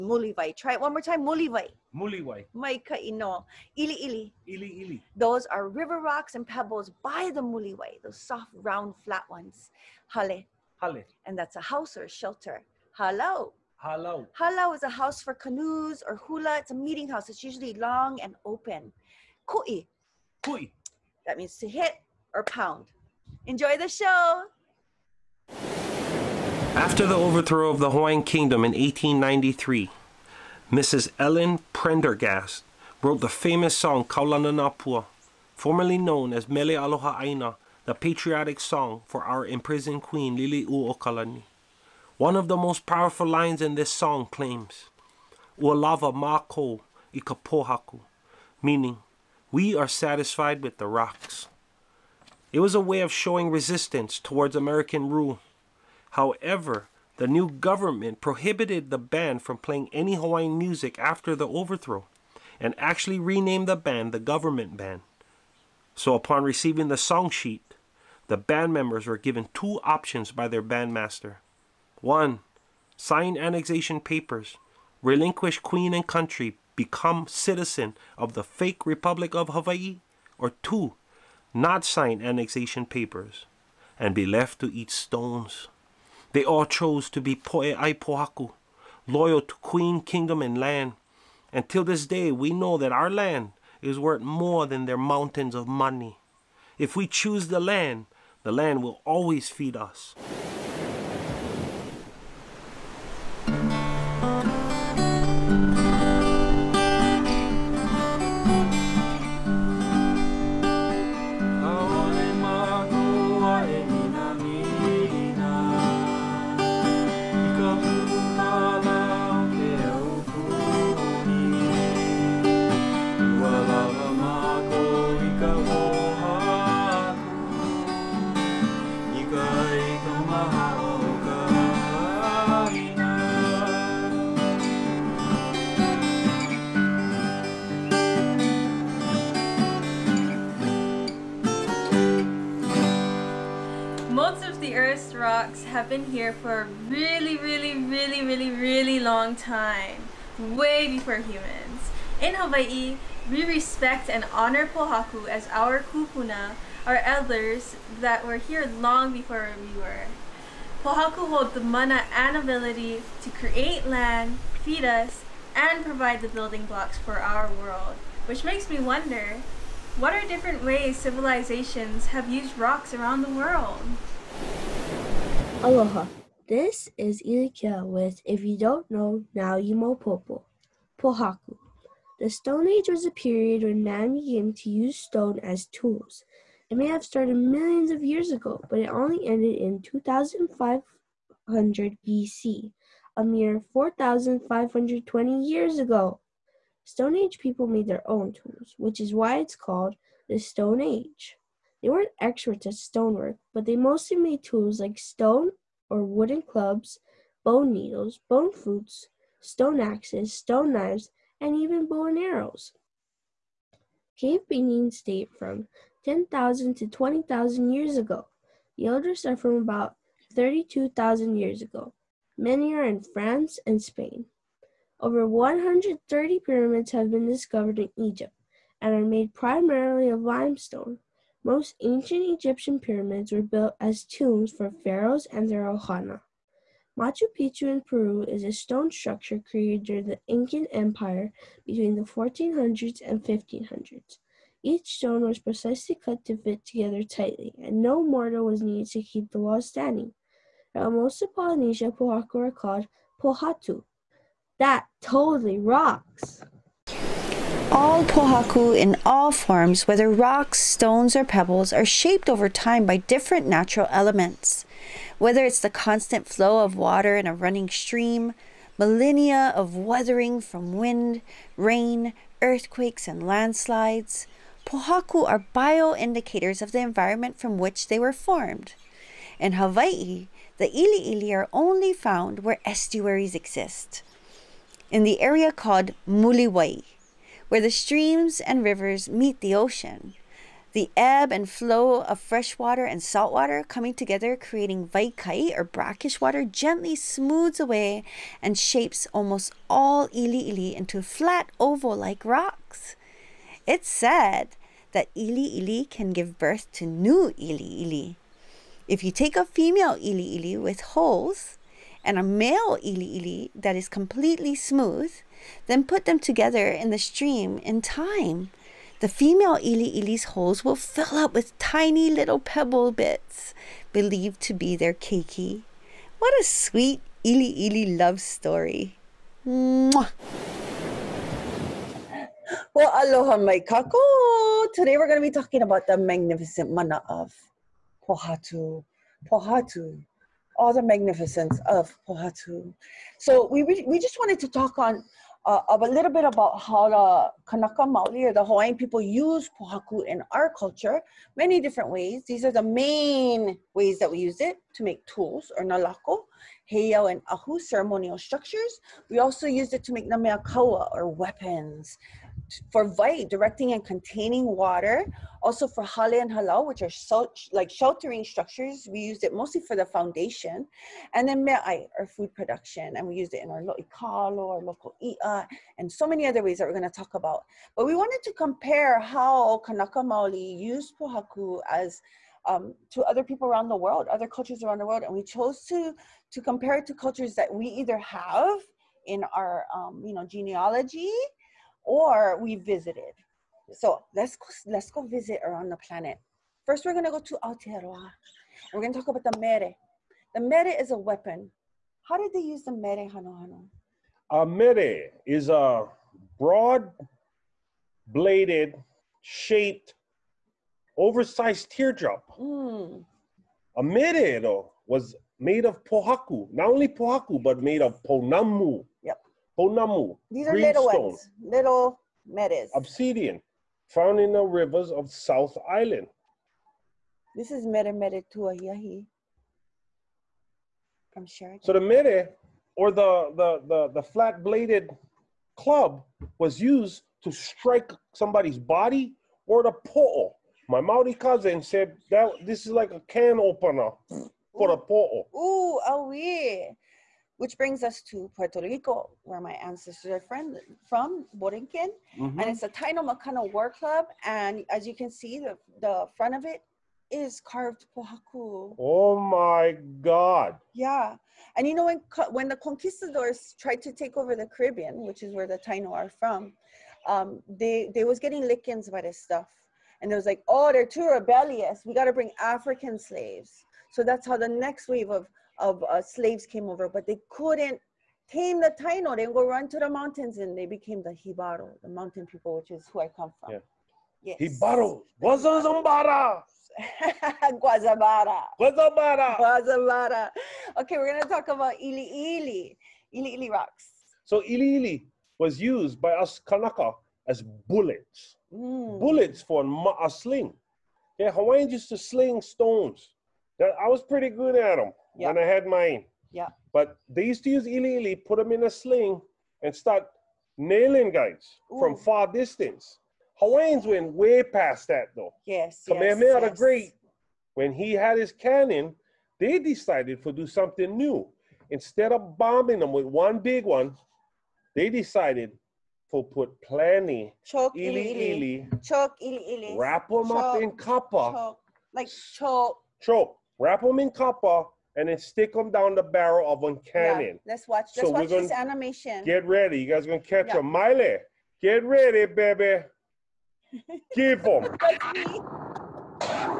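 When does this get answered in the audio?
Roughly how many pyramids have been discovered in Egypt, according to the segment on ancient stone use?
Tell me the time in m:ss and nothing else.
3:45.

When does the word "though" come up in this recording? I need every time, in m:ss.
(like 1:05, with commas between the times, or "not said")
6:54, 8:35.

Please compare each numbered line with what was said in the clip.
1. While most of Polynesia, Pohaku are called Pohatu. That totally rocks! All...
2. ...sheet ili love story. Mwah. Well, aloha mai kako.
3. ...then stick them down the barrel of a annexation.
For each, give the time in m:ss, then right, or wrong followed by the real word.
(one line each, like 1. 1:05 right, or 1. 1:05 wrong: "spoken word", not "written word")
1. 4:10 right
2. 5:26 wrong: "sweet", not "sheet"
3. 8:55 wrong: "cannon", not "annexation".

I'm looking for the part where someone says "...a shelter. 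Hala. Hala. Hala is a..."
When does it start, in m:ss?
0:12.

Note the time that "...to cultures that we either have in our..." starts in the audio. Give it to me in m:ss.
6:26.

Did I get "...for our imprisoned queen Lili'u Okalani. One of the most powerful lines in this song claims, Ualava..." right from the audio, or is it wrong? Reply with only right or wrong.
right.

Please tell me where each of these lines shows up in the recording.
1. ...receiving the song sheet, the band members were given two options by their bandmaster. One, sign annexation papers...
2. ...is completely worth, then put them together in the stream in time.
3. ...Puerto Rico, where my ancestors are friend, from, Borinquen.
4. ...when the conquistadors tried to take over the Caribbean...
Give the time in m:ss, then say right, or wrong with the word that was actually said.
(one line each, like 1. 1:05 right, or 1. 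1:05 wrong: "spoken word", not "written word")
1. 1:06 right
2. 5:13 wrong: "smooth", not "worth"
3. 7:28 right
4. 7:42 right.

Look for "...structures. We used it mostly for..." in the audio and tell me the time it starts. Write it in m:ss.
6:08.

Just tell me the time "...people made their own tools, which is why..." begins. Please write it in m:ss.
3:17.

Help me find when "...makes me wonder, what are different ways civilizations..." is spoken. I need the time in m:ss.
2:48.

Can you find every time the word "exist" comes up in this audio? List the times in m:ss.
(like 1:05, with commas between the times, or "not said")
4:43.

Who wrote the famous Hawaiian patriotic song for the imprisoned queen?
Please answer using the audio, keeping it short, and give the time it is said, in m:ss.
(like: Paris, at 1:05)
Ellen Prendergast, at 0:31.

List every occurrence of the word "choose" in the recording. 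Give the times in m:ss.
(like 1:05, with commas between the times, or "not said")
1:37.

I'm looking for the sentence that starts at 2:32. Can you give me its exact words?
In Hawaii, we respect and honor Pohaku as our kupuna, our elders that were here long before we were.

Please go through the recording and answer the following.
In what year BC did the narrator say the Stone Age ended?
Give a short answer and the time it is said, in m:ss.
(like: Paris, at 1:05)
2500 BC, at 3:09.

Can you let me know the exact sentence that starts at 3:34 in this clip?
Cave paintings date from 10,000 to 20,000 years ago.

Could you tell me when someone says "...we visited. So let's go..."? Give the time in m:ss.
6:32.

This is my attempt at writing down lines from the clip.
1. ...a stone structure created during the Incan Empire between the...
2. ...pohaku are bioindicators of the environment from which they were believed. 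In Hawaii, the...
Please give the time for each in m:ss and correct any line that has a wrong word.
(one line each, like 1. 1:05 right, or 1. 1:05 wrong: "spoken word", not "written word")
1. 3:58 right
2. 4:34 wrong: "formed", not "believed".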